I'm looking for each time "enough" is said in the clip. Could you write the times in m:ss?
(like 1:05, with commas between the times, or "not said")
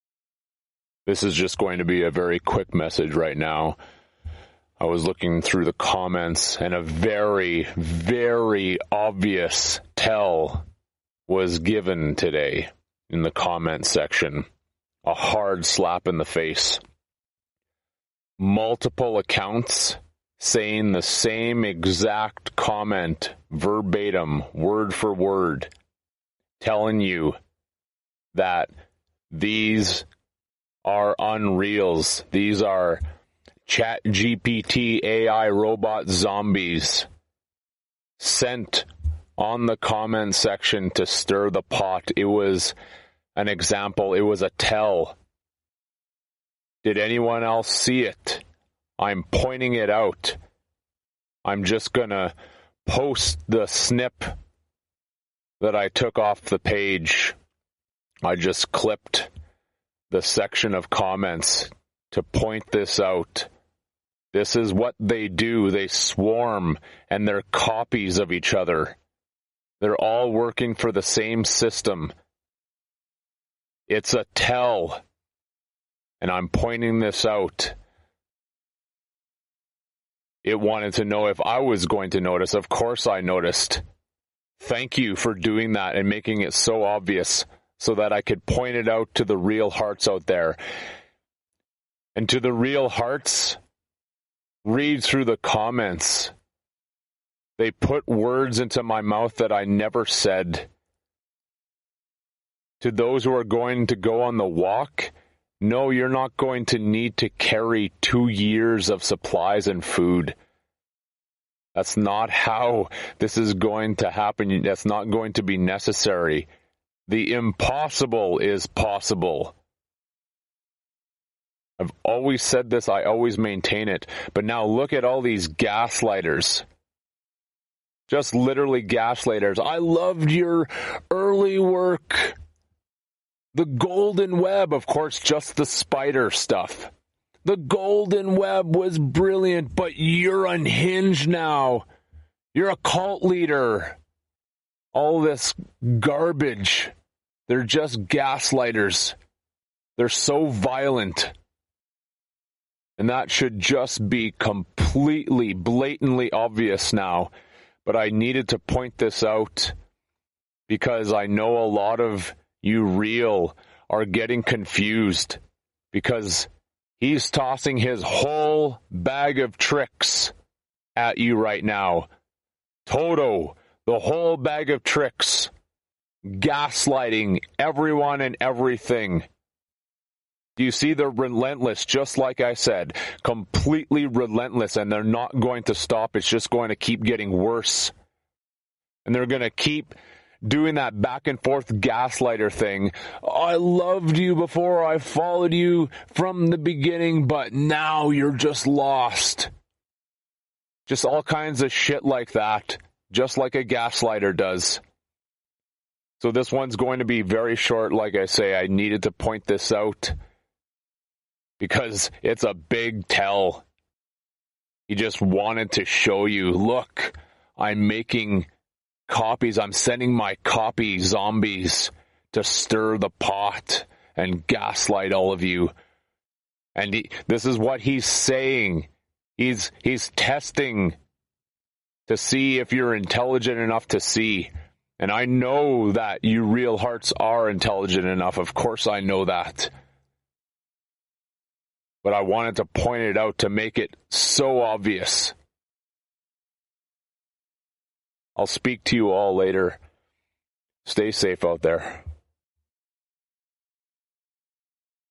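3:53, 3:58.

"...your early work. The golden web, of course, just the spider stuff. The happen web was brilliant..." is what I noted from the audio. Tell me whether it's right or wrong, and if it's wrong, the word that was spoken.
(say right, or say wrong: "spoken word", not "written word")
wrong: "golden", not "happen".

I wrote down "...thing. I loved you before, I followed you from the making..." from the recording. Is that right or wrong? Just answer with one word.
wrong.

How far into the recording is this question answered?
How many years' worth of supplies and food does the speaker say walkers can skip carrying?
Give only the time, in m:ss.
1:47.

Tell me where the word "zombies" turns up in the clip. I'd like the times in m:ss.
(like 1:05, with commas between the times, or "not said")
0:36, 3:40.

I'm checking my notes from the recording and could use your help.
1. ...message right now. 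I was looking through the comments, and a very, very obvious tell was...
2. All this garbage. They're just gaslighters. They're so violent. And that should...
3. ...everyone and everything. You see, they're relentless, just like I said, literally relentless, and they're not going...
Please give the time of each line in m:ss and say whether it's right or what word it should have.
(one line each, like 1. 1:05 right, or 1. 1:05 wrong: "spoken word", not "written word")
1. 0:02 right
2. 2:24 right
3. 2:57 wrong: "completely", not "literally".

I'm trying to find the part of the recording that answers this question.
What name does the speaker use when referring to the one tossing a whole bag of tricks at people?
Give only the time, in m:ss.
2:52.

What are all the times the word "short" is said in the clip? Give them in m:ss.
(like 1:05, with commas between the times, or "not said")
3:27.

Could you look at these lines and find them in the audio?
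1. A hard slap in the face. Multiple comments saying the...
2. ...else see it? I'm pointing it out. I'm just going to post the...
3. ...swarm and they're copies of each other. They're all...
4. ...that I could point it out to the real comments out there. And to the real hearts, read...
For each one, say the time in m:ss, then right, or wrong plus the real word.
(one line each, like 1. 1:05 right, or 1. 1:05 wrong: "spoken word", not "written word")
1. 0:15 wrong: "accounts", not "comments"
2. 0:47 right
3. 1:05 right
4. 1:27 wrong: "hearts", not "comments".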